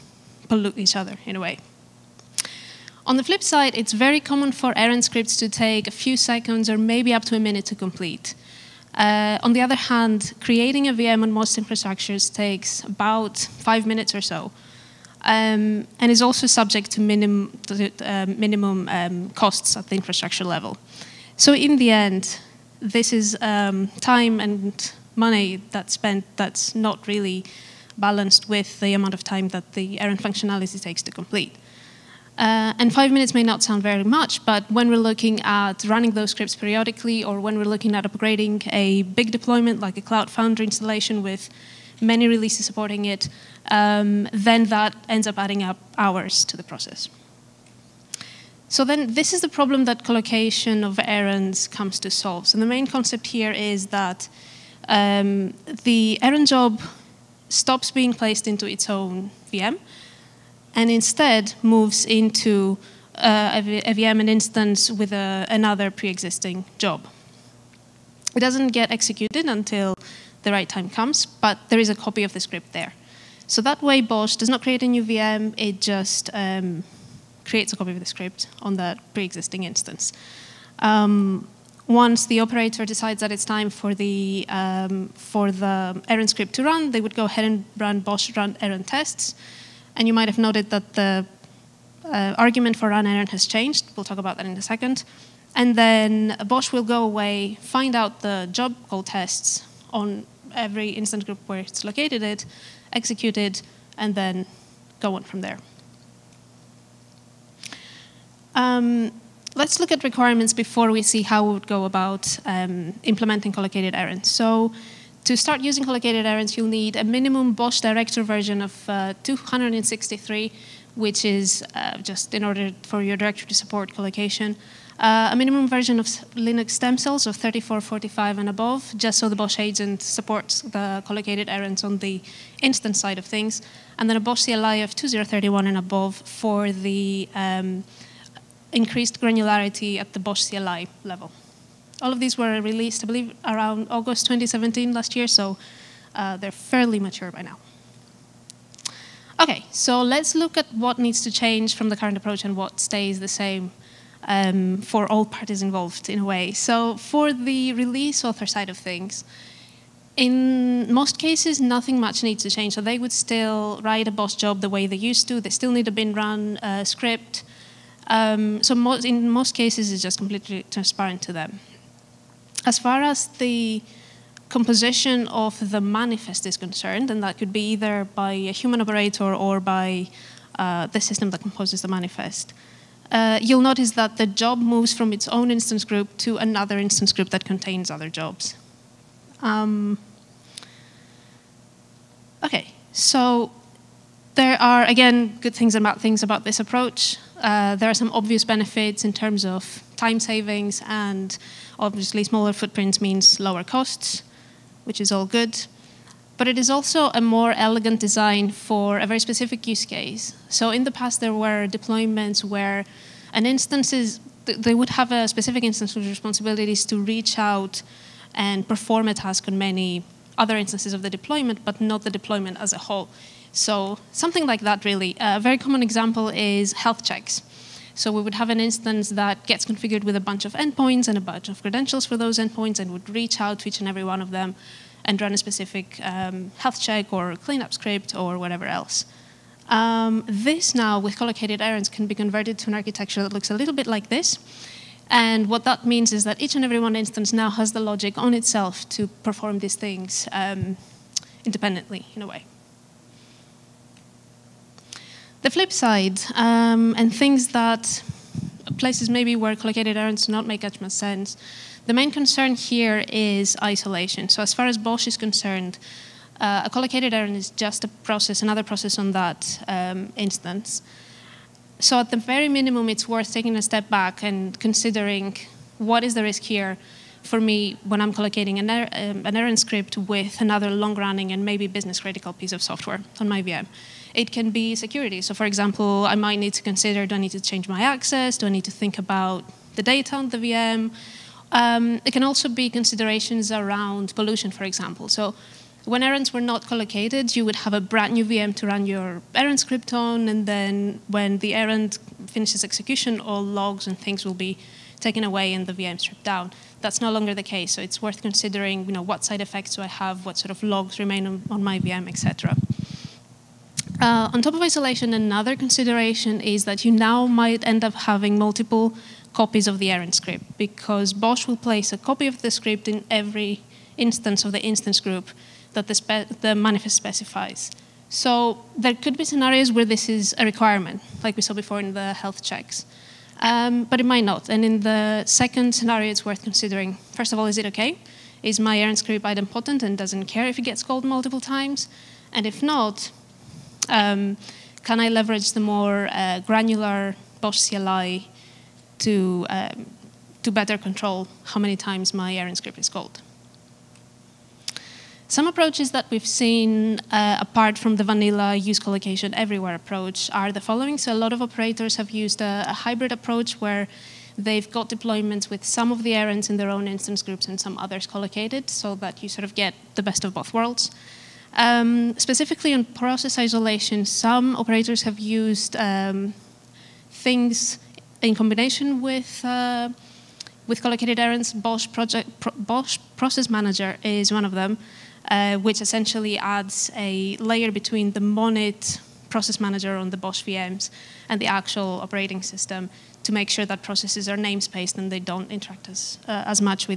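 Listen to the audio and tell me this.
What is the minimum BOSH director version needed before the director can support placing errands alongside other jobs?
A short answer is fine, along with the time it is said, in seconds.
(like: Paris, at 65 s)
263, at 119 s.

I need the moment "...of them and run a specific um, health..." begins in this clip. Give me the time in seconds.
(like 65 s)
234 s.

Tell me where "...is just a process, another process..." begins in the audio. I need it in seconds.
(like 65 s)
267 s.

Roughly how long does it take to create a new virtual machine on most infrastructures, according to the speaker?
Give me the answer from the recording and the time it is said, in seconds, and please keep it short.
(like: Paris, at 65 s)
5 minutes, at 12 s.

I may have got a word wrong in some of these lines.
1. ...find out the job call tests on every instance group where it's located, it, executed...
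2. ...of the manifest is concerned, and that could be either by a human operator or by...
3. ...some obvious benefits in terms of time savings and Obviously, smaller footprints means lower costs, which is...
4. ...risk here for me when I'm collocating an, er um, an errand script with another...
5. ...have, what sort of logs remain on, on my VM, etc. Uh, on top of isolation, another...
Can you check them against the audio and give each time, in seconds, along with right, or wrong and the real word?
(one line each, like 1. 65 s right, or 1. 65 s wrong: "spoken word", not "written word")
1. 97 s right
2. 175 s right
3. 197 s right
4. 276 s right
5. 309 s right.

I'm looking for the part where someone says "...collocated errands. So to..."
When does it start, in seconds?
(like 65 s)
113 s.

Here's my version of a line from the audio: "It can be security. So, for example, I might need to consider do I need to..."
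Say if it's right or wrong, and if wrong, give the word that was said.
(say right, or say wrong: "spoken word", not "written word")
right.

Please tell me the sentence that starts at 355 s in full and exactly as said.
Some approaches that we've seen, uh, apart from the vanilla use collocation everywhere approach, are the following.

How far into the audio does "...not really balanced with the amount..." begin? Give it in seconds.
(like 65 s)
26 s.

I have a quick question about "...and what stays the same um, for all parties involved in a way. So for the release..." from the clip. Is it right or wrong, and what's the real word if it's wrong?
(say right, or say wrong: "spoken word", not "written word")
right.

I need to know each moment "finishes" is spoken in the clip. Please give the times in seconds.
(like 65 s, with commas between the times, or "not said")
302 s.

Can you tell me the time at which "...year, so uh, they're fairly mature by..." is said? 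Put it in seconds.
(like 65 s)
145 s.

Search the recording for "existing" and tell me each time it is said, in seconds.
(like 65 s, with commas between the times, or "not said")
65 s, 79 s.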